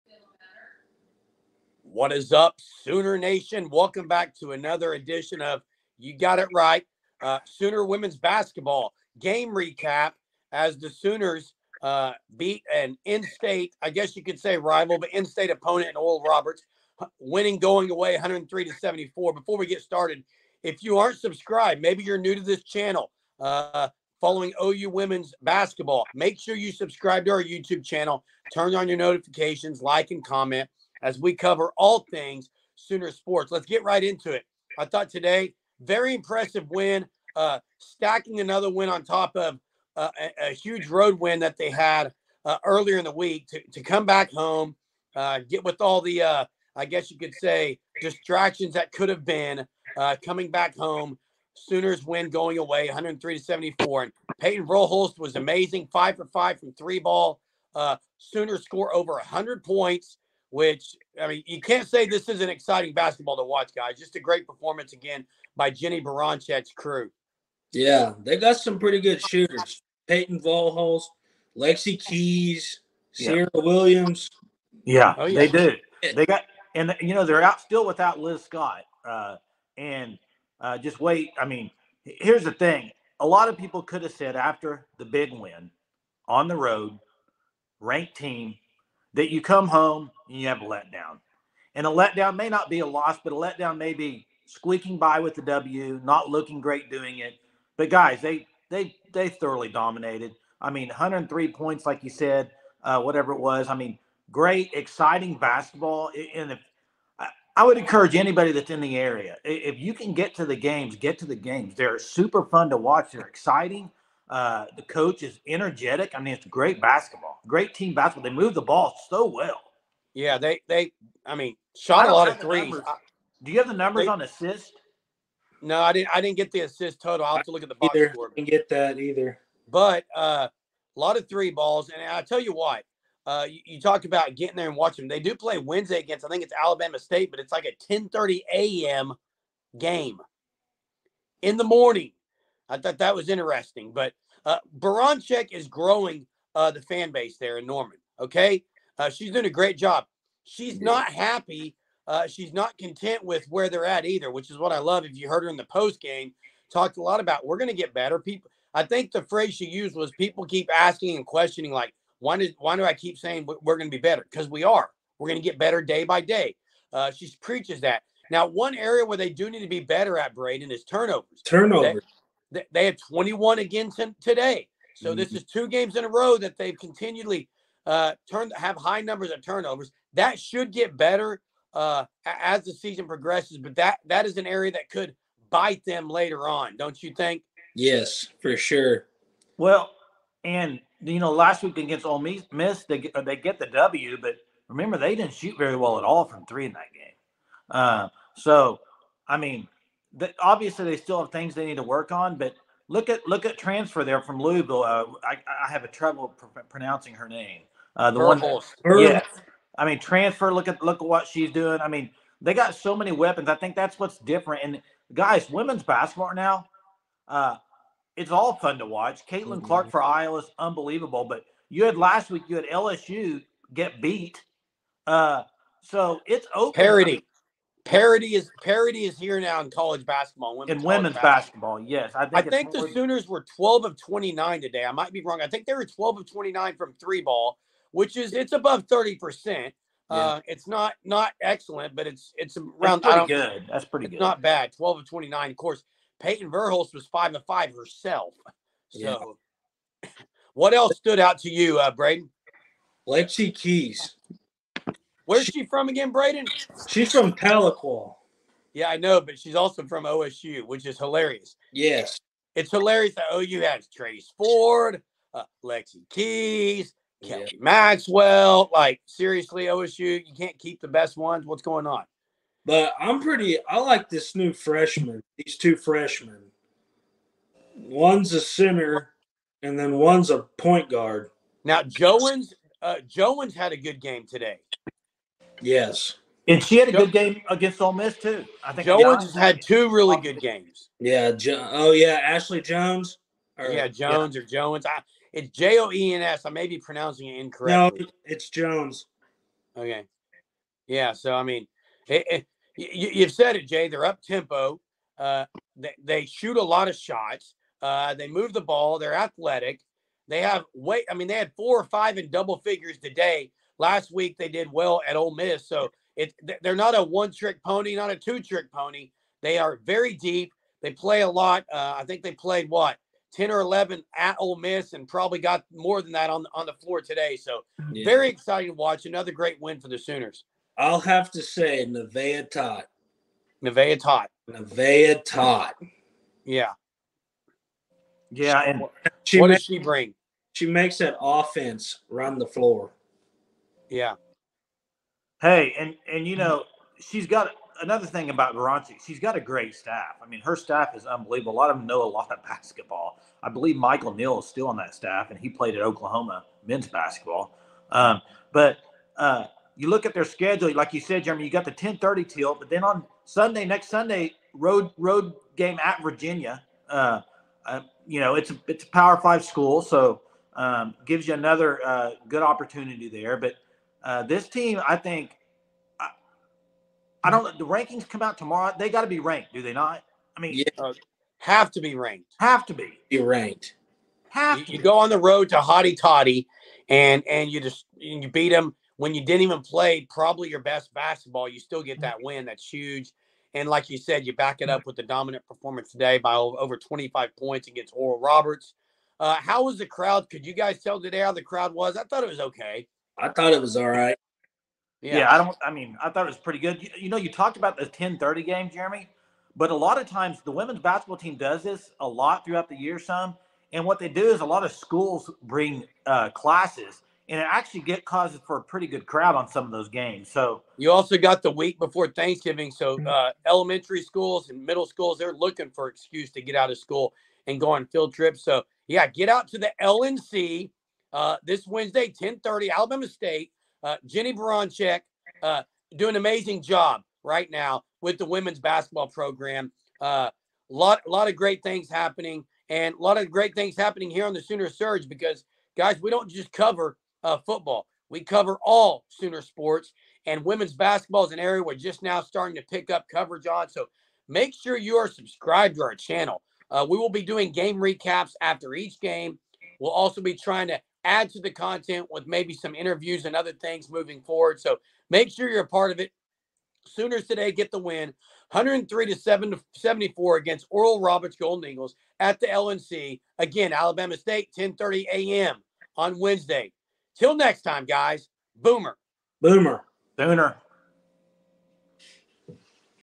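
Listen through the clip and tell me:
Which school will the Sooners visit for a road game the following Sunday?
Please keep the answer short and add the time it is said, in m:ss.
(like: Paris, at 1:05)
Virginia, at 6:06.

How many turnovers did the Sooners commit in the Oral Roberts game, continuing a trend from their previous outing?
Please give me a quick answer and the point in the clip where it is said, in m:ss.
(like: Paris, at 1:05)
21, at 2:52.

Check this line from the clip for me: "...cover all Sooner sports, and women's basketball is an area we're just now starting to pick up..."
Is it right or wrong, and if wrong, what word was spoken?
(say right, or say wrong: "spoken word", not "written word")
right.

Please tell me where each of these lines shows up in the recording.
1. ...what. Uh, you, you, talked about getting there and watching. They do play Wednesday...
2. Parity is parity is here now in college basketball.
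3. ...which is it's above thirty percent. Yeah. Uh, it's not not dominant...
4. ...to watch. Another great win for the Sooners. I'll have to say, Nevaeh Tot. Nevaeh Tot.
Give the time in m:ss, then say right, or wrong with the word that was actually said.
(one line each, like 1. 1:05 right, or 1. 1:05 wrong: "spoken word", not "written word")
1. 2:12 right
2. 3:47 right
3. 3:57 wrong: "excellent", not "dominant"
4. 5:28 right.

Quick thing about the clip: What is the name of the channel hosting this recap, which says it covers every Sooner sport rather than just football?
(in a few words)
Sooner Surge.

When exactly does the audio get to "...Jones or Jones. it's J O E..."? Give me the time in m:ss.
4:53.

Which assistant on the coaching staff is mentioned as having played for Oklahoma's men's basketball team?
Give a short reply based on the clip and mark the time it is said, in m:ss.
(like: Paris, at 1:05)
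Michael Neal, at 5:53.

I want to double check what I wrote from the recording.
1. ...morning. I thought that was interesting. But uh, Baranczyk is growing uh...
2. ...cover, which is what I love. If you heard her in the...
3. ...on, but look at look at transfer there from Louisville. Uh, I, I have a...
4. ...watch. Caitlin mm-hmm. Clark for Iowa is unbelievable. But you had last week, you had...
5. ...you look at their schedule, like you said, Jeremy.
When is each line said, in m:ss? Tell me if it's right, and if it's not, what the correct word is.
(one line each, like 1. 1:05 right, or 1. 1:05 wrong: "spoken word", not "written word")
1. 2:21 right
2. 2:34 wrong: "either", not "cover"
3. 3:22 right
4. 3:38 right
5. 5:59 right.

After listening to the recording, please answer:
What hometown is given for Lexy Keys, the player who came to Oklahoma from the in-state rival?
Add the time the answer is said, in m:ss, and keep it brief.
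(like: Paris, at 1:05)
Tahlequah, at 4:17.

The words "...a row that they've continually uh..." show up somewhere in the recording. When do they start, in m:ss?
2:56.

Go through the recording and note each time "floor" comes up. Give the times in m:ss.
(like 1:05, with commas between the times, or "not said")
5:26, 5:42.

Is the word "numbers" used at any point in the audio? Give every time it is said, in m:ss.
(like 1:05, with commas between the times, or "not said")
2:03, 2:59.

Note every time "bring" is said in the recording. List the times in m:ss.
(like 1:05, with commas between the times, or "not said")
5:39, 6:55.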